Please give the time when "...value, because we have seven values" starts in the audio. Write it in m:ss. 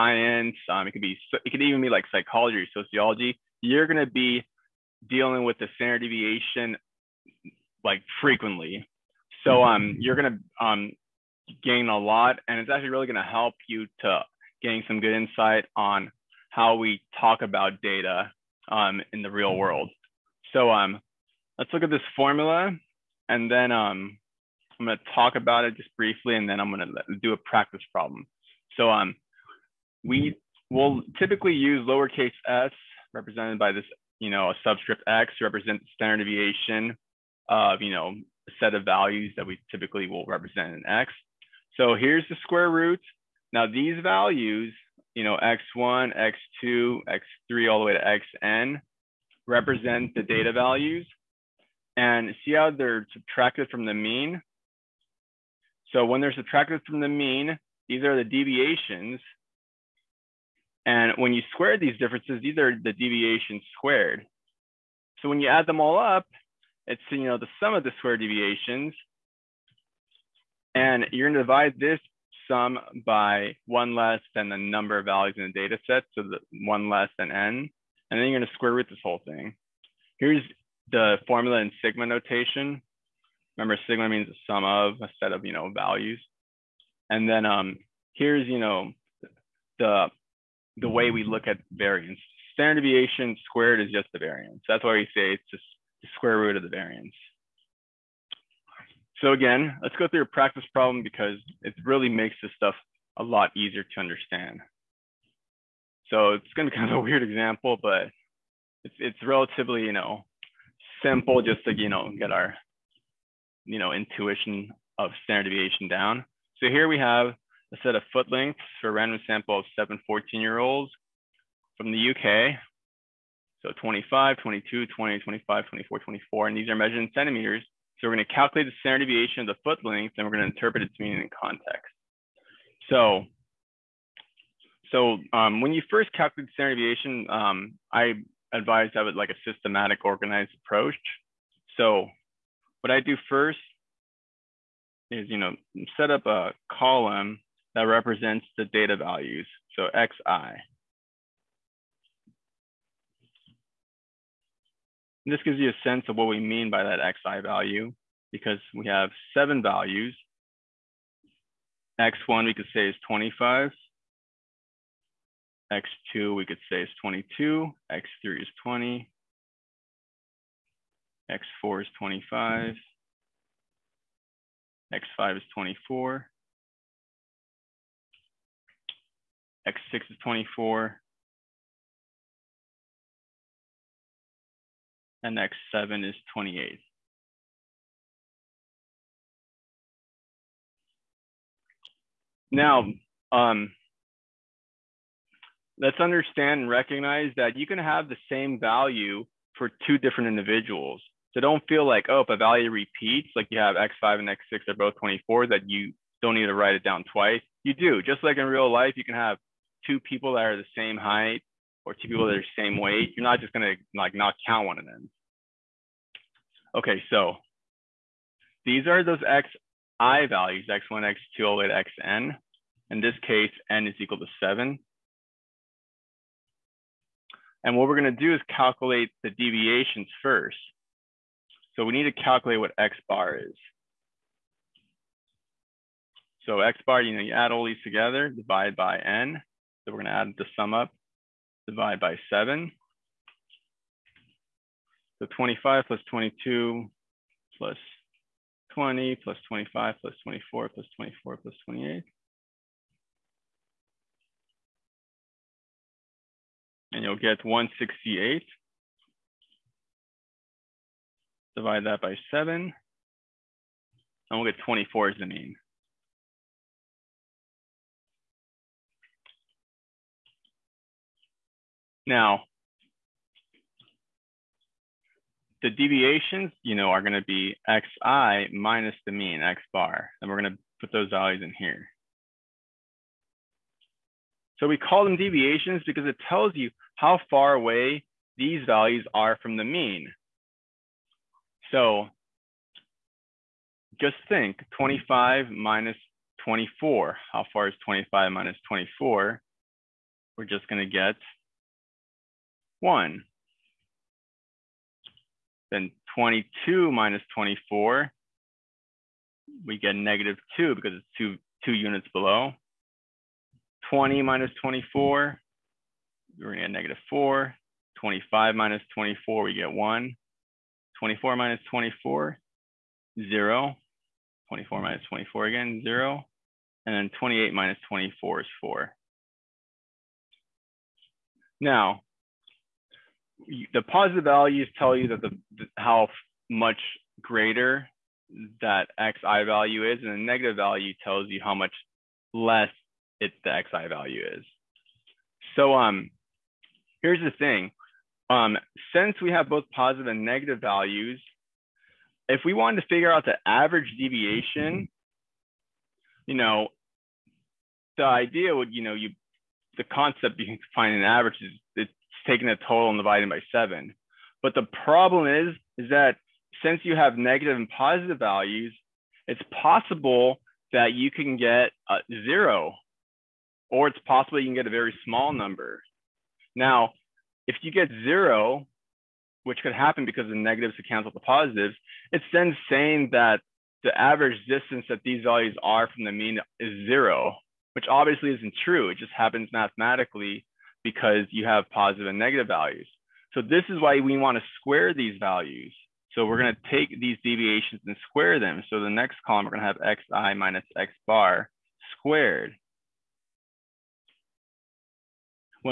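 2:37.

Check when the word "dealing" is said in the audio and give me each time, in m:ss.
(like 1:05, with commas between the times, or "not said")
0:05.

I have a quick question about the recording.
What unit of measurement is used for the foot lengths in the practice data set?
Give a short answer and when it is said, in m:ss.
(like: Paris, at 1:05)
centimeters, at 2:07.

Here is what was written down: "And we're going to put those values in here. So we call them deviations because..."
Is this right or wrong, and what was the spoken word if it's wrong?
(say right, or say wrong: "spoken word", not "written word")
right.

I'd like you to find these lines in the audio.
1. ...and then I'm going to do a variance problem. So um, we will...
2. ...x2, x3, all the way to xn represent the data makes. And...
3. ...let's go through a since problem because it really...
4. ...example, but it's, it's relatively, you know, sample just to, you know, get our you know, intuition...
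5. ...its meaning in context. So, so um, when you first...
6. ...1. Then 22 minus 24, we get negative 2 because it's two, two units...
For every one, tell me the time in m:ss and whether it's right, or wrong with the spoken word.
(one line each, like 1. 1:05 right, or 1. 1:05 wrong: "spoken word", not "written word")
1. 0:26 wrong: "practice", not "variance"
2. 0:46 wrong: "values", not "makes"
3. 1:39 wrong: "practice", not "since"
4. 1:47 wrong: "simple", not "sample"
5. 2:10 right
6. 5:02 right.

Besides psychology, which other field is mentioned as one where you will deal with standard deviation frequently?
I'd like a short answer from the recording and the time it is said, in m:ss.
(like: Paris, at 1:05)
sociology, at 0:02.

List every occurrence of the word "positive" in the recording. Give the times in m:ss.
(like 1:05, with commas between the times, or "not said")
5:33, 5:49, 6:07, 6:21, 6:31.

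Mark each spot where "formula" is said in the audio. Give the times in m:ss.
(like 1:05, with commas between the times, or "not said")
0:22, 1:21.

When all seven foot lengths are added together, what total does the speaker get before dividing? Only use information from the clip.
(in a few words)
168.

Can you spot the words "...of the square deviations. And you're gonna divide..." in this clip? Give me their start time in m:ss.
1:07.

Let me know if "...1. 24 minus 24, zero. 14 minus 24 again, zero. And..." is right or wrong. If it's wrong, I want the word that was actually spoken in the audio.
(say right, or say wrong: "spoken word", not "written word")
wrong: "24", not "14".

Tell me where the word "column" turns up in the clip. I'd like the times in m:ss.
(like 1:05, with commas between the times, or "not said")
2:26, 6:39.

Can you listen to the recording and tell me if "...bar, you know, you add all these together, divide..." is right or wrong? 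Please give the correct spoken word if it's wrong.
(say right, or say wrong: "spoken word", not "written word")
right.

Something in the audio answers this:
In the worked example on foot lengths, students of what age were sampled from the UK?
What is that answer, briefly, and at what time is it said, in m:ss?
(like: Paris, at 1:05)
14, at 2:00.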